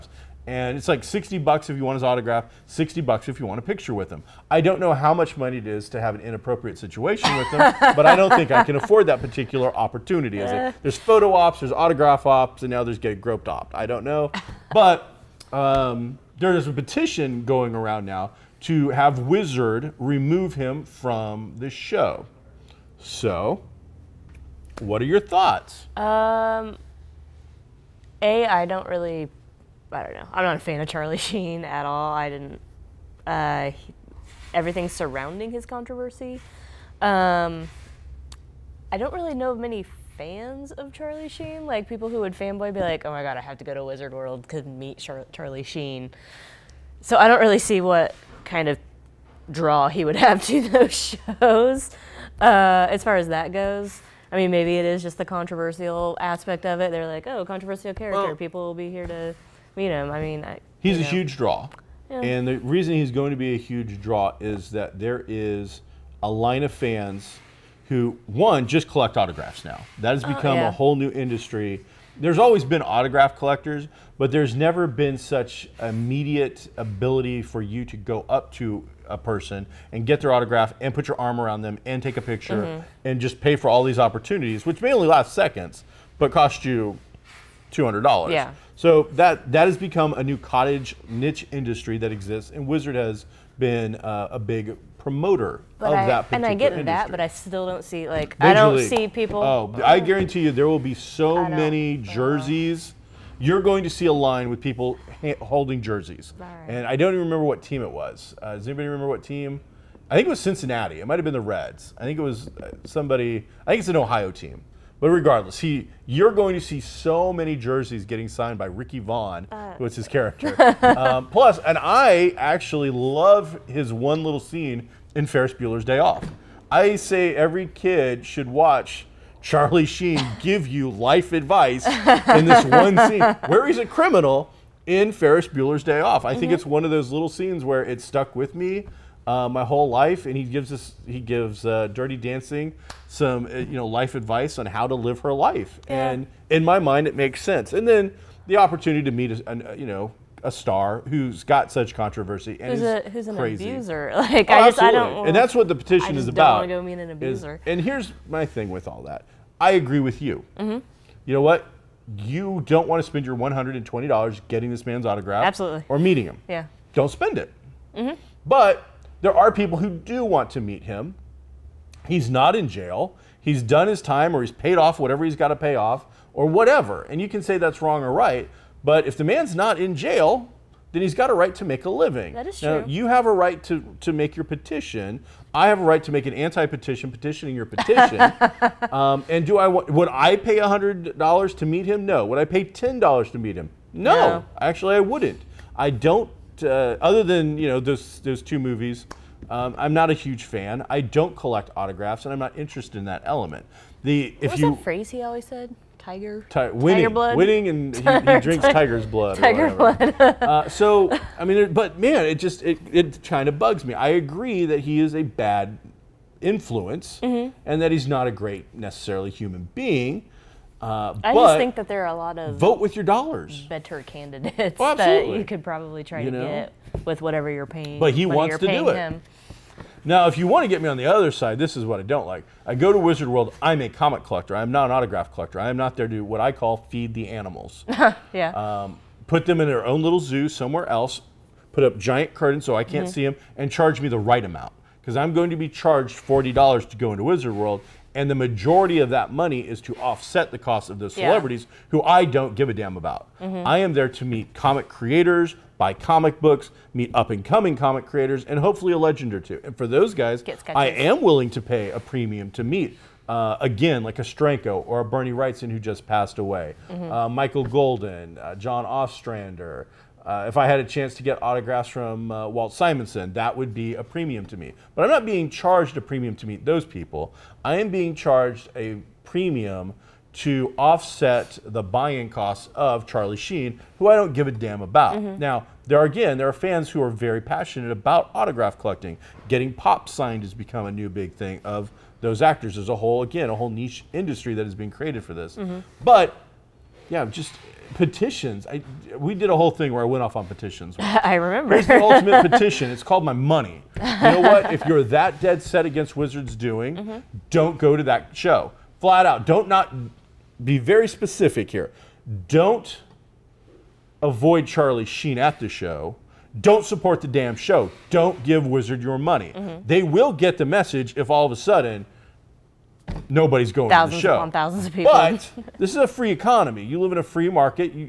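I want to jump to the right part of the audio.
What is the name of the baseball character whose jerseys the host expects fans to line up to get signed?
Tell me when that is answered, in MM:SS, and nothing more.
01:58.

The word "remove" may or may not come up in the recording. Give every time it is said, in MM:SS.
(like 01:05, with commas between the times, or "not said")
00:19.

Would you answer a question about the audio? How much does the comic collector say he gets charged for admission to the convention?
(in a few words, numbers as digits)
$40.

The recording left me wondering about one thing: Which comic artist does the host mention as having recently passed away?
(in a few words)
Bernie Wrightson.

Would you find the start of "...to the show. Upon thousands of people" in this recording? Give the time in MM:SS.
05:24.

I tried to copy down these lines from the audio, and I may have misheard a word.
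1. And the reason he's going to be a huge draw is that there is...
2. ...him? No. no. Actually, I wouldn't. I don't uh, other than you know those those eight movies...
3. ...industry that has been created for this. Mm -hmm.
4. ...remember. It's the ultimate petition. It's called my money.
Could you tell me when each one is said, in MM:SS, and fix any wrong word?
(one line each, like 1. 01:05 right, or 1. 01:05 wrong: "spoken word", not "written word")
1. 01:02 right
2. 03:13 wrong: "two", not "eight"
3. 04:54 right
4. 05:01 right.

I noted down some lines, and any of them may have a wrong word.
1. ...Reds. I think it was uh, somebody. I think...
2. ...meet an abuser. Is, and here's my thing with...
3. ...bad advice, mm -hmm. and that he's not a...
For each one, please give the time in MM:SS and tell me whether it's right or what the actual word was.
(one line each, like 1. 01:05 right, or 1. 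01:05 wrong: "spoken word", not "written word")
1. 01:51 right
2. 02:36 right
3. 03:35 wrong: "influence", not "advice".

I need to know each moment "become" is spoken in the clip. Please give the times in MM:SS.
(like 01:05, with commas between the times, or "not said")
01:10, 01:29, 04:50.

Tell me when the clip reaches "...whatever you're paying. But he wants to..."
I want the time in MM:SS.
03:47.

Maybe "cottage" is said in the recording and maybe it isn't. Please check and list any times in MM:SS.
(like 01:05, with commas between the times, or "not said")
01:30.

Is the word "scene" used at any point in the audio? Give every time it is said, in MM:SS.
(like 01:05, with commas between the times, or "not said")
02:04, 02:13, 02:17.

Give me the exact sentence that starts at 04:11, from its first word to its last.
celebrities who I don't give a damn about.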